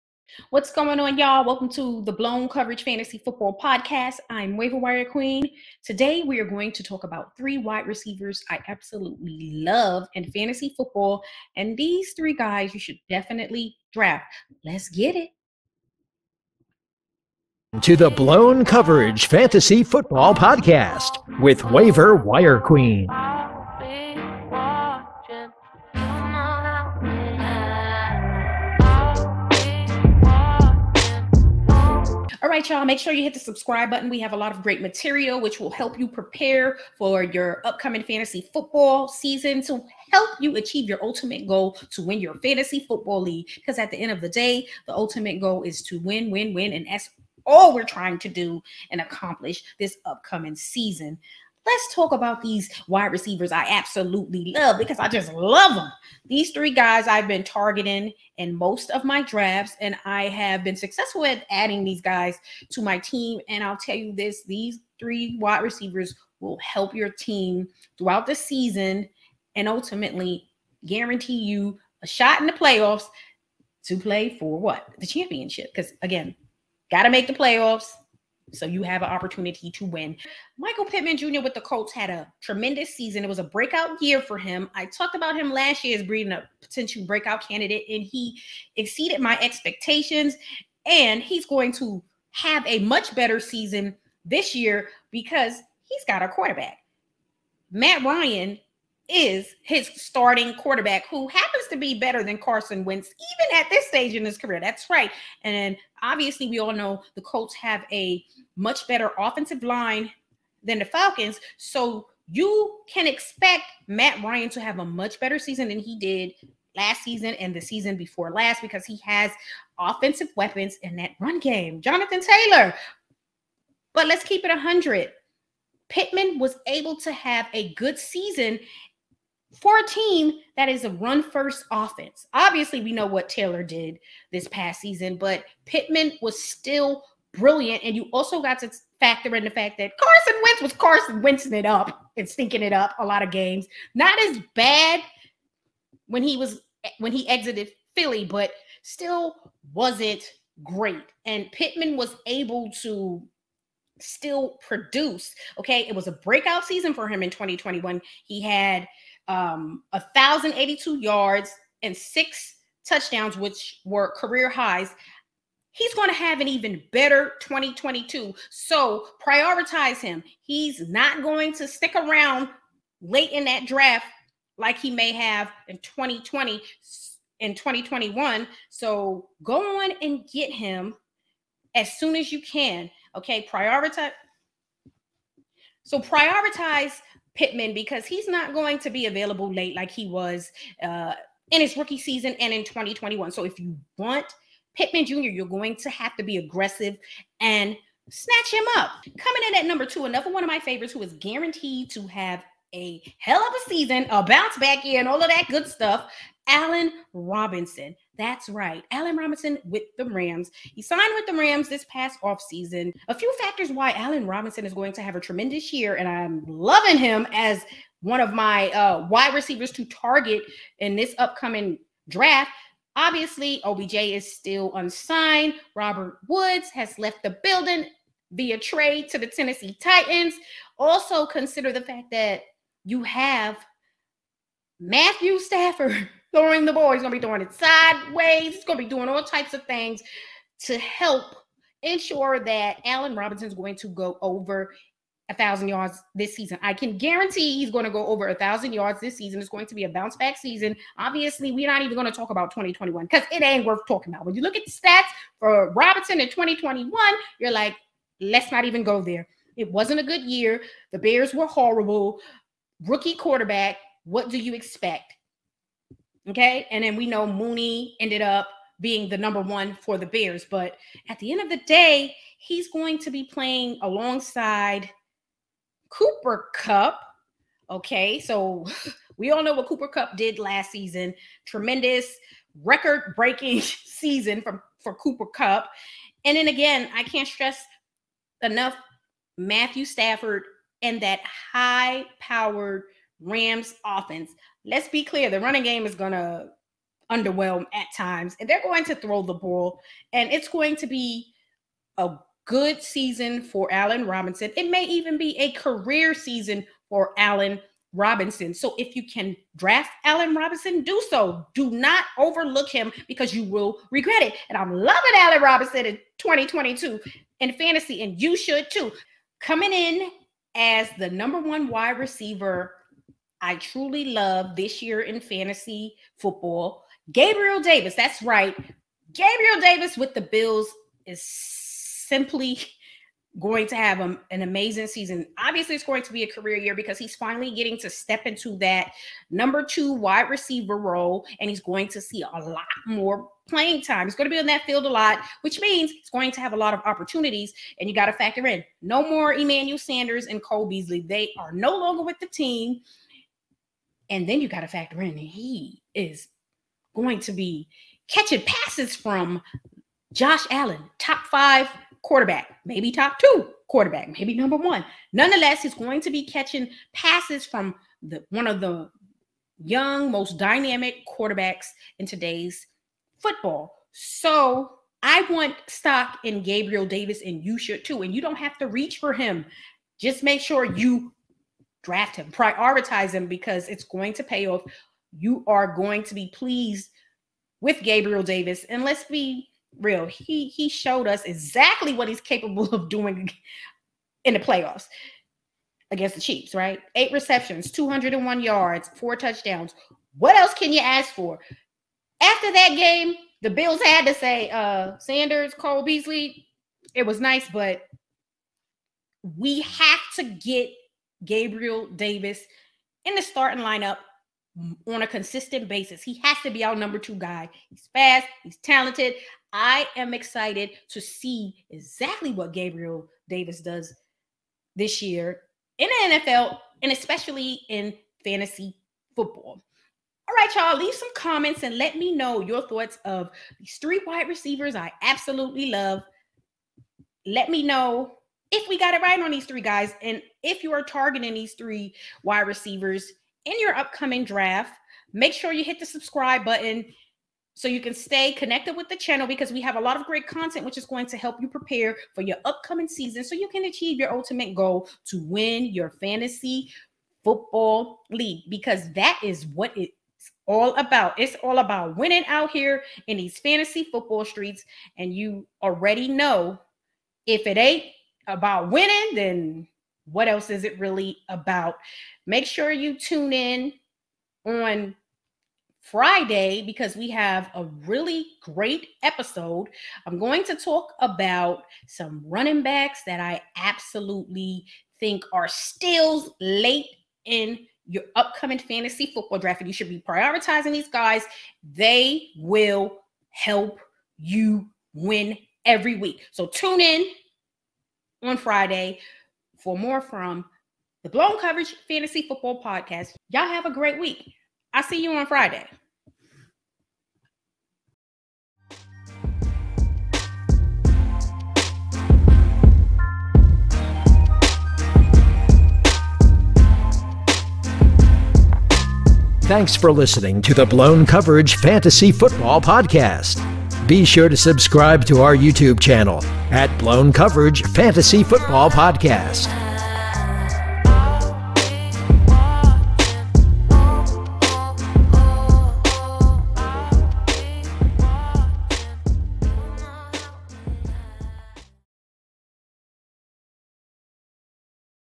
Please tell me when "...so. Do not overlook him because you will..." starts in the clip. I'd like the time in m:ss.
5:11.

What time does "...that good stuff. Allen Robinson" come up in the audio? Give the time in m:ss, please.
3:25.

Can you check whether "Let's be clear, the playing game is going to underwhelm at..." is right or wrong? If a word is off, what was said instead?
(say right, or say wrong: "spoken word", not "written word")
wrong: "running", not "playing".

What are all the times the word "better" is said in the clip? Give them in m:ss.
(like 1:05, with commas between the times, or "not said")
1:33, 1:41, 1:48, 1:55, 2:46.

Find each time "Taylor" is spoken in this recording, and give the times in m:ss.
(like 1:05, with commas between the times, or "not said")
2:02, 2:13.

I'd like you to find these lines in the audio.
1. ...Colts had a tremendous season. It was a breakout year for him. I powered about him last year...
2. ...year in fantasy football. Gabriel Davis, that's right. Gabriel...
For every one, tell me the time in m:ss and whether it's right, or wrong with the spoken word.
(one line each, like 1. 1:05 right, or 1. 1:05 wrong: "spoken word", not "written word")
1. 1:21 wrong: "talked", not "powered"
2. 5:24 right.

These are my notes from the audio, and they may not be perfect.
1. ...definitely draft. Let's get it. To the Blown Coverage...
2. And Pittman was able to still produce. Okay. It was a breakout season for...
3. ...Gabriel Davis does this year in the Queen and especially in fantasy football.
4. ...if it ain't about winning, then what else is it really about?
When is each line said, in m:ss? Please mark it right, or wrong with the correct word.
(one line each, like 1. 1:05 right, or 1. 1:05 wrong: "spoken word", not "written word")
1. 0:13 right
2. 2:31 right
3. 7:02 wrong: "NFL", not "Queen"
4. 7:47 right.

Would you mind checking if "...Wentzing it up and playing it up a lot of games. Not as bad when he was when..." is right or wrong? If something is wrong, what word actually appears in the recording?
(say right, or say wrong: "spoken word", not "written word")
wrong: "stinking", not "playing".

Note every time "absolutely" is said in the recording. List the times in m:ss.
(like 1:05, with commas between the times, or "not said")
0:08, 0:53, 7:15, 8:03.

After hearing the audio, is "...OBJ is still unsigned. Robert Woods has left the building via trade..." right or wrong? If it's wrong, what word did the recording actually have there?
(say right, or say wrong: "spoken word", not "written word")
right.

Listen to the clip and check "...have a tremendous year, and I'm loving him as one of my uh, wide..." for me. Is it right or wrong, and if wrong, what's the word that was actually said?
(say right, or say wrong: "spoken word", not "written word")
right.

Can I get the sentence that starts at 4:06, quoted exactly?
I can guarantee he's going to go over a thousand yards this season.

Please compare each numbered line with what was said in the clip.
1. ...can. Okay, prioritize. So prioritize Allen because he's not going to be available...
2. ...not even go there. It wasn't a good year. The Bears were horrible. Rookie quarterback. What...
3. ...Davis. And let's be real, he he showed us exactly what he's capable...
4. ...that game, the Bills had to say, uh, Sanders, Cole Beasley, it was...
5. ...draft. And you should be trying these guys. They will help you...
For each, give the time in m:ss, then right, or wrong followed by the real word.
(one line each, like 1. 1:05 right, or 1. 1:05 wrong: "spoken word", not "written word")
1. 3:02 wrong: "Pittman", not "Allen"
2. 4:18 right
3. 6:28 right
4. 6:42 right
5. 8:09 wrong: "prioritizing", not "trying".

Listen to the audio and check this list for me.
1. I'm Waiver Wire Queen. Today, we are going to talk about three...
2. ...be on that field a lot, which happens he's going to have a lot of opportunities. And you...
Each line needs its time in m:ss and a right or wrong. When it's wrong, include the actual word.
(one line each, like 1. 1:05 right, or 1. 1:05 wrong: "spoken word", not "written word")
1. 0:04 right
2. 5:44 wrong: "means", not "happens".